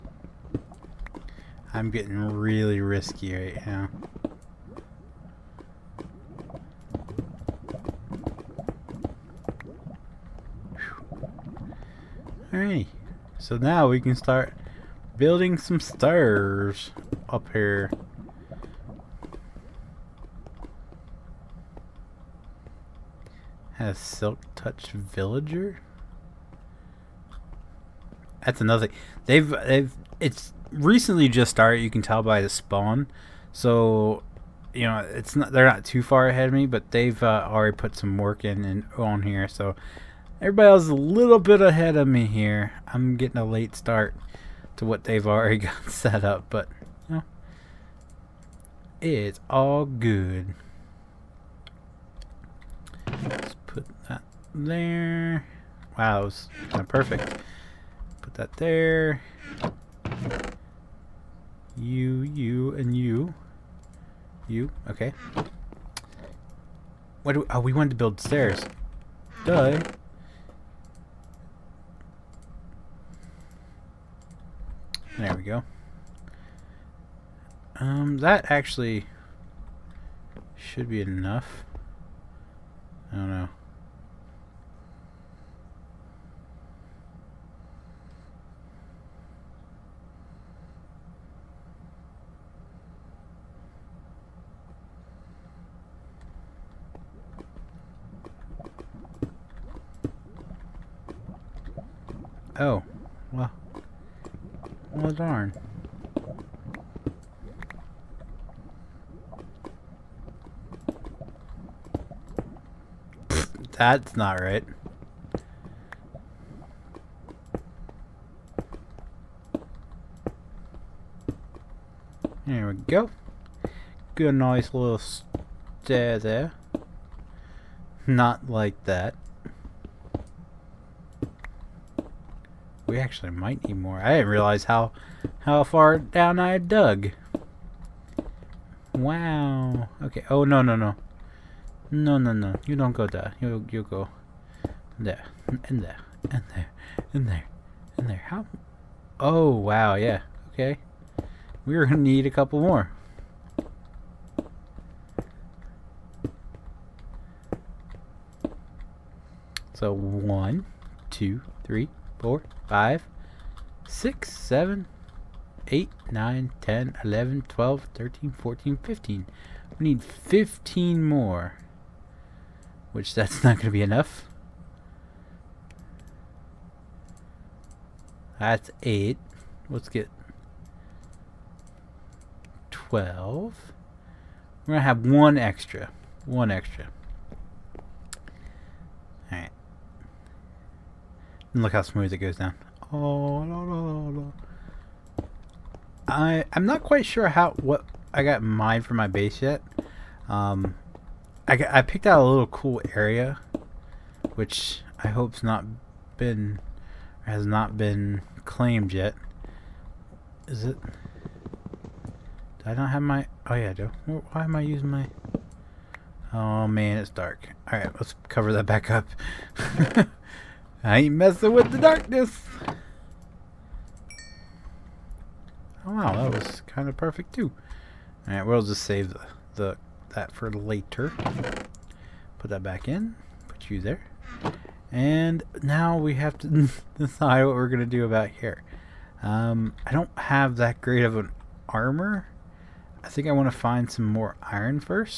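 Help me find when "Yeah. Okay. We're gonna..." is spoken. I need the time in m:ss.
2:29.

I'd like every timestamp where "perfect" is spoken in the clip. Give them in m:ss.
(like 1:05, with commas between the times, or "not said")
0:56, 3:46.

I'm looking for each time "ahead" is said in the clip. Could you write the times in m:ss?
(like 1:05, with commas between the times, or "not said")
0:36, 0:41.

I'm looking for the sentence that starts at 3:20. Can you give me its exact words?
Um, I, I picked out a little cool area, which I hope's not been has not been claimed yet.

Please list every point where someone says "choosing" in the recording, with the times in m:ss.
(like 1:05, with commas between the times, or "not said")
not said.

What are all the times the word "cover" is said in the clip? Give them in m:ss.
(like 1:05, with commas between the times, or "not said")
3:38.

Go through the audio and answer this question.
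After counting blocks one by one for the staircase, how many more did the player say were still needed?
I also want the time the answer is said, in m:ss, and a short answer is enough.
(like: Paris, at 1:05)
15, at 2:49.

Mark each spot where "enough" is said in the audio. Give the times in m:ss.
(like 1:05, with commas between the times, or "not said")
1:21, 2:53.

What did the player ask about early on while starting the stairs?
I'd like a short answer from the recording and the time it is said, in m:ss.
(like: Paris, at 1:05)
Silk touch, at 0:23.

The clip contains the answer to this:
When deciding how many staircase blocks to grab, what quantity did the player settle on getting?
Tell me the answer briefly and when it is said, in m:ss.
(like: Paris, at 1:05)
12, at 2:59.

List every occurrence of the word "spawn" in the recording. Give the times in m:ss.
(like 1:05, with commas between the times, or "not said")
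0:32.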